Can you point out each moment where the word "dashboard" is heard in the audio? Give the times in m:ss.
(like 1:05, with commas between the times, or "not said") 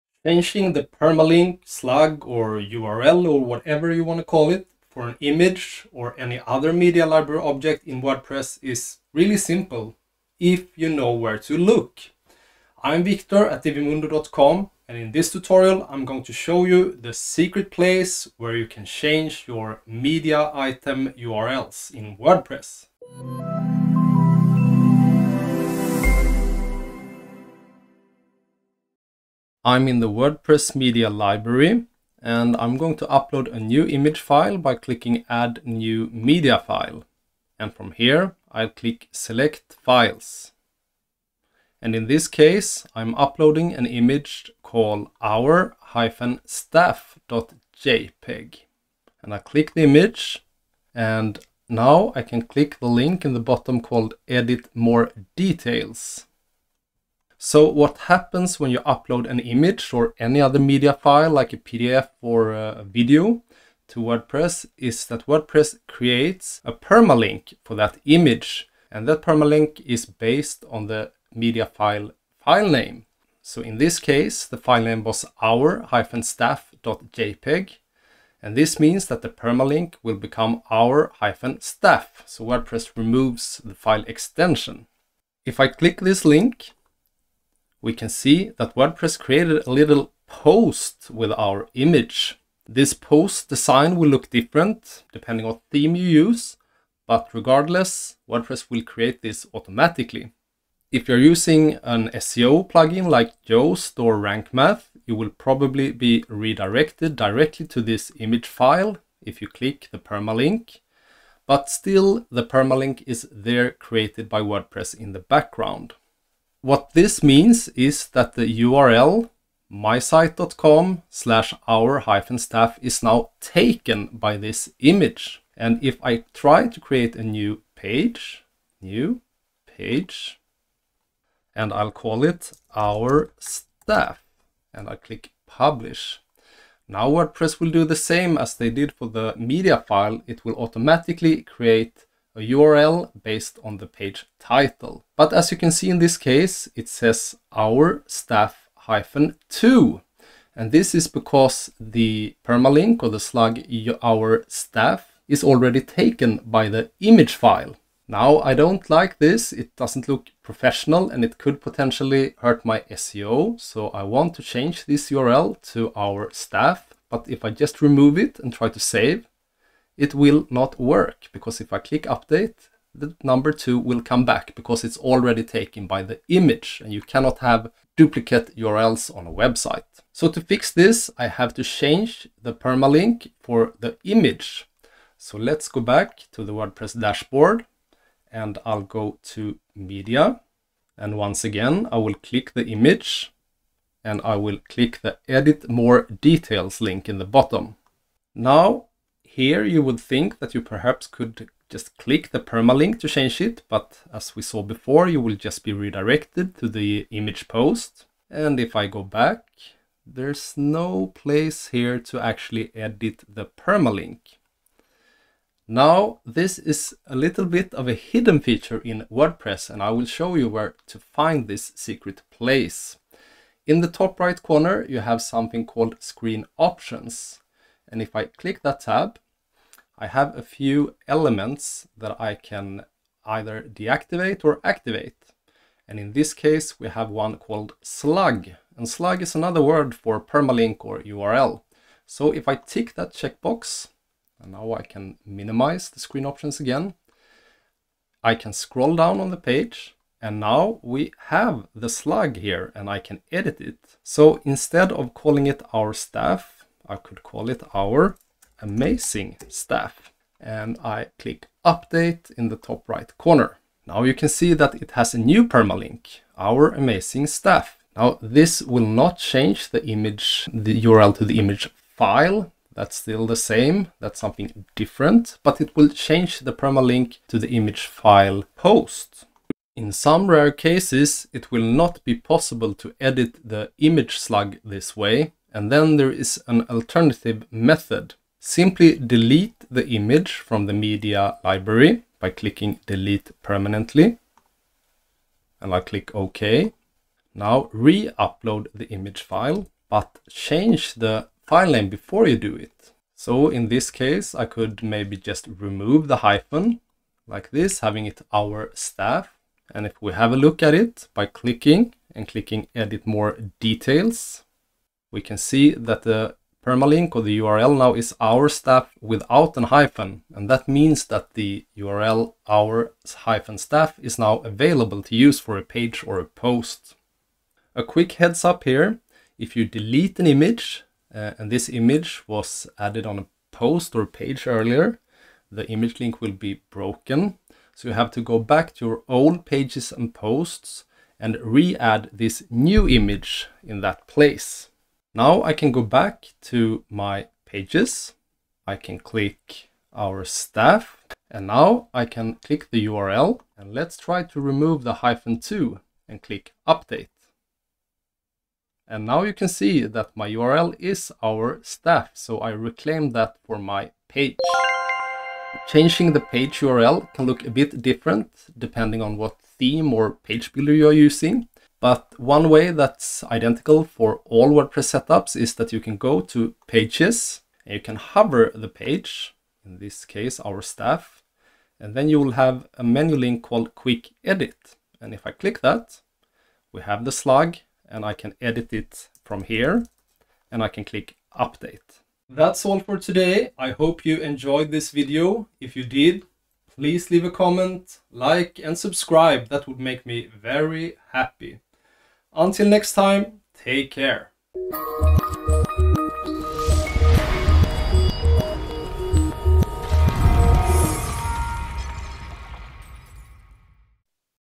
3:06.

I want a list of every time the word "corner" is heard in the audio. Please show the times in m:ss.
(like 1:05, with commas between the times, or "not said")
3:44, 4:23.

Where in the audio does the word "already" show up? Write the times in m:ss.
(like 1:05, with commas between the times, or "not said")
2:35, 2:54.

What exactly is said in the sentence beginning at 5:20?
And that means that the URL our hyphen staff is now available to use for a page or a post.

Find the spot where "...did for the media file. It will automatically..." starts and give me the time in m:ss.
2:18.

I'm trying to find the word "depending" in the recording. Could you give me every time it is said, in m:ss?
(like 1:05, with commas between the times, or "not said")
1:35, 6:08.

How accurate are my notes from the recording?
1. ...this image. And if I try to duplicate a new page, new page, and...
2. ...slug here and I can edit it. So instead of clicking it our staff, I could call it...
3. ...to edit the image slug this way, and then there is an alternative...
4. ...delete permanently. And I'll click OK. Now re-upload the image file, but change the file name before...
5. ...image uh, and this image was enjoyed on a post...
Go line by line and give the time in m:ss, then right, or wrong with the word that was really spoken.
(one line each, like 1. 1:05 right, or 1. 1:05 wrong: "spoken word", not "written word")
1. 2:04 wrong: "create", not "duplicate"
2. 4:11 wrong: "calling", not "clicking"
3. 4:42 right
4. 4:52 right
5. 5:30 wrong: "added", not "enjoyed".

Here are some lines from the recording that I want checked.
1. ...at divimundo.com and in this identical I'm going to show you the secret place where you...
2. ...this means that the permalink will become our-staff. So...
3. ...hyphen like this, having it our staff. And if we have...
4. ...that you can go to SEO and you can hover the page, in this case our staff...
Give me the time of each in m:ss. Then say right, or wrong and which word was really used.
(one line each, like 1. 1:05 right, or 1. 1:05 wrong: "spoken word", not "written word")
1. 0:13 wrong: "tutorial", not "identical"
2. 1:18 right
3. 5:06 right
4. 6:15 wrong: "Pages", not "SEO".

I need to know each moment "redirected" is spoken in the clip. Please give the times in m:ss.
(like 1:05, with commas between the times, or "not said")
1:46, 3:25.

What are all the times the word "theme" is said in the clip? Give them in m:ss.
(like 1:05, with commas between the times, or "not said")
1:35, 6:09.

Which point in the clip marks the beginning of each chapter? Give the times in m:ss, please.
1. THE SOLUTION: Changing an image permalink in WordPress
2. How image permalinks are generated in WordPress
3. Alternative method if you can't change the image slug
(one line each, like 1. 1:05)
1. 3:00
2. 0:29
3. 4:39.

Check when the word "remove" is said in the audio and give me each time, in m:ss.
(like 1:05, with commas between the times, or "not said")
1:22, 2:47, 5:05, 5:54.